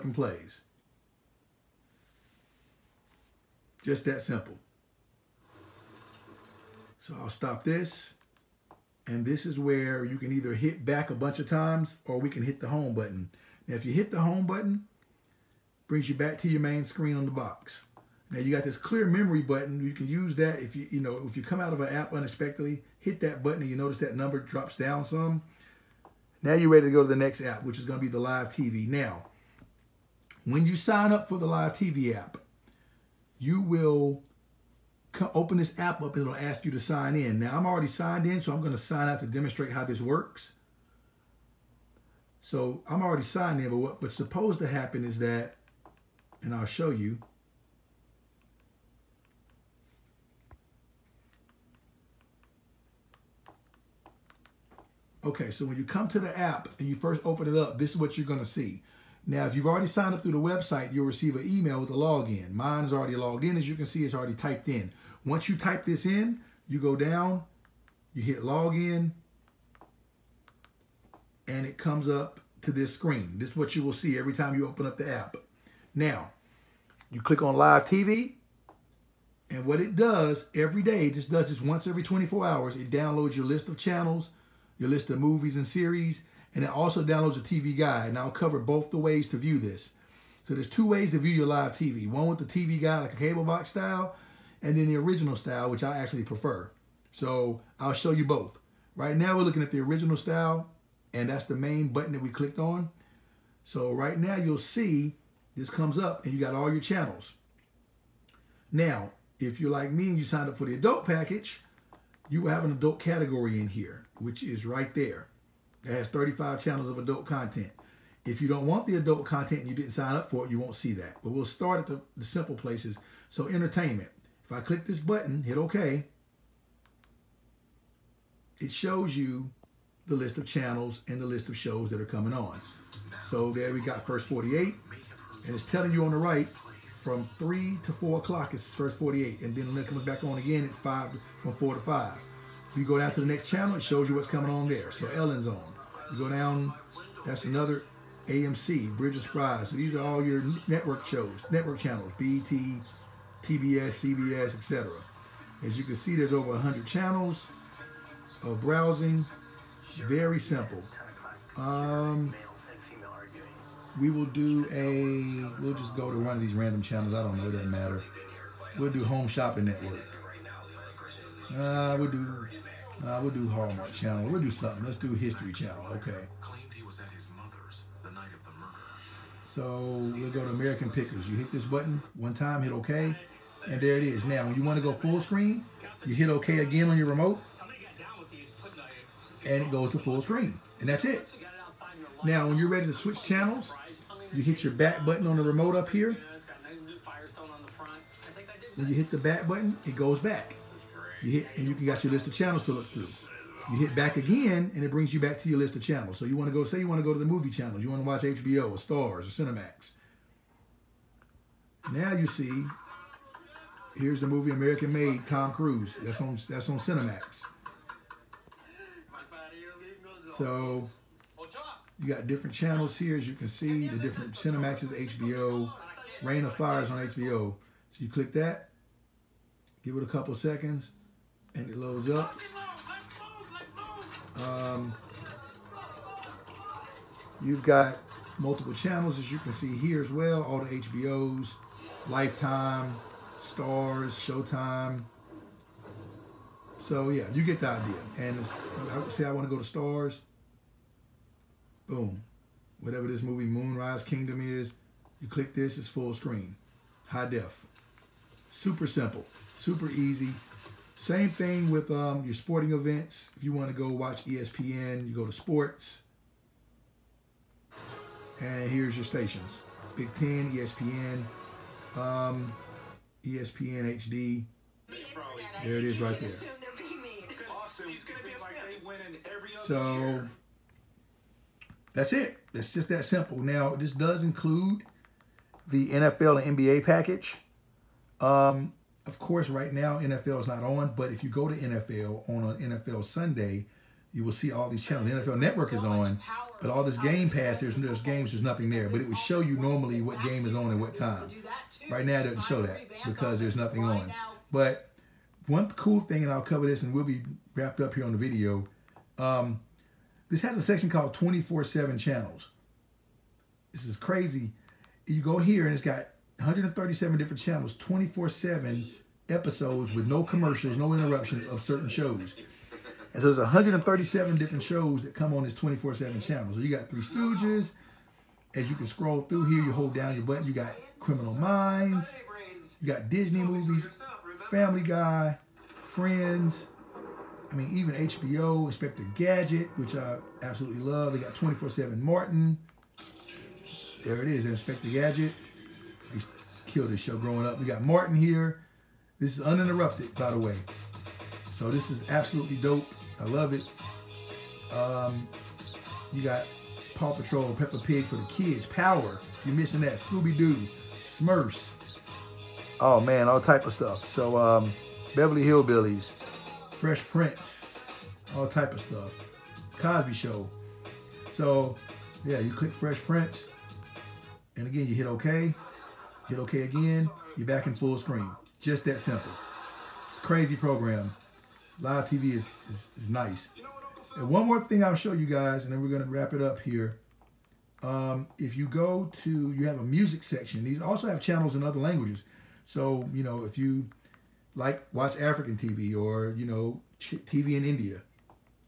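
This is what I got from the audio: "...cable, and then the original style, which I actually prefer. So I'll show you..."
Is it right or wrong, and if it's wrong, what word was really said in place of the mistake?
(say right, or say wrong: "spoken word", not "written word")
wrong: "style", not "cable".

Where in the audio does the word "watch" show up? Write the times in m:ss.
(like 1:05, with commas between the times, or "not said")
3:28, 4:23, 6:34.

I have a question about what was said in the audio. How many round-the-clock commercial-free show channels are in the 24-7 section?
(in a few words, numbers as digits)
137.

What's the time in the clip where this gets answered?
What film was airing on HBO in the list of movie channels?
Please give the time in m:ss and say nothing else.
3:46.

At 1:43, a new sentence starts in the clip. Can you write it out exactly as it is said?
So right now you'll see this comes up and you got all your channels.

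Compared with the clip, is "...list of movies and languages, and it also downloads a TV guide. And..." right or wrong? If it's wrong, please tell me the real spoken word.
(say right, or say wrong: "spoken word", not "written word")
wrong: "series", not "languages".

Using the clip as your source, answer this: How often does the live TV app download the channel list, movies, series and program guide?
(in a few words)
once every 24 hours.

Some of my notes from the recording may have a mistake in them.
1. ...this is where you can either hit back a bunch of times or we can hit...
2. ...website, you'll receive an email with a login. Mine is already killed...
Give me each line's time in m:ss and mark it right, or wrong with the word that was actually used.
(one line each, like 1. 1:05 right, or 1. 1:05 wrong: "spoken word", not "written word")
1. 0:09 right
2. 1:00 wrong: "logged", not "killed".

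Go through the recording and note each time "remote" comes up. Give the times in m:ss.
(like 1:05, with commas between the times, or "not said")
3:07, 3:15.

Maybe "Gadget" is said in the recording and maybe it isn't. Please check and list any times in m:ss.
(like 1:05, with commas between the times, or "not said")
5:39, 5:44.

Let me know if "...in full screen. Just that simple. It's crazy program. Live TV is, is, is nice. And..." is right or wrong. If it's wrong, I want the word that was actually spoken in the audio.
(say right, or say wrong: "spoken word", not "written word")
right.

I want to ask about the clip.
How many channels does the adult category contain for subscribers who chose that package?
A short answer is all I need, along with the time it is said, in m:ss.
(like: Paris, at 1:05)
35, at 1:56.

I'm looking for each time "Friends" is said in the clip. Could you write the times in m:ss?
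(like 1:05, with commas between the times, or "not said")
5:35.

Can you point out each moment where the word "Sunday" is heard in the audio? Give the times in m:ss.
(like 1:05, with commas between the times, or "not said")
4:53.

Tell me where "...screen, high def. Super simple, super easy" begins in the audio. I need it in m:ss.
4:16.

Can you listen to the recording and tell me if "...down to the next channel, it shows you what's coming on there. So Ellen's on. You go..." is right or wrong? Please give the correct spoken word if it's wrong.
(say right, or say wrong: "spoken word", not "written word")
right.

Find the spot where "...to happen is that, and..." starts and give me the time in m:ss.
0:44.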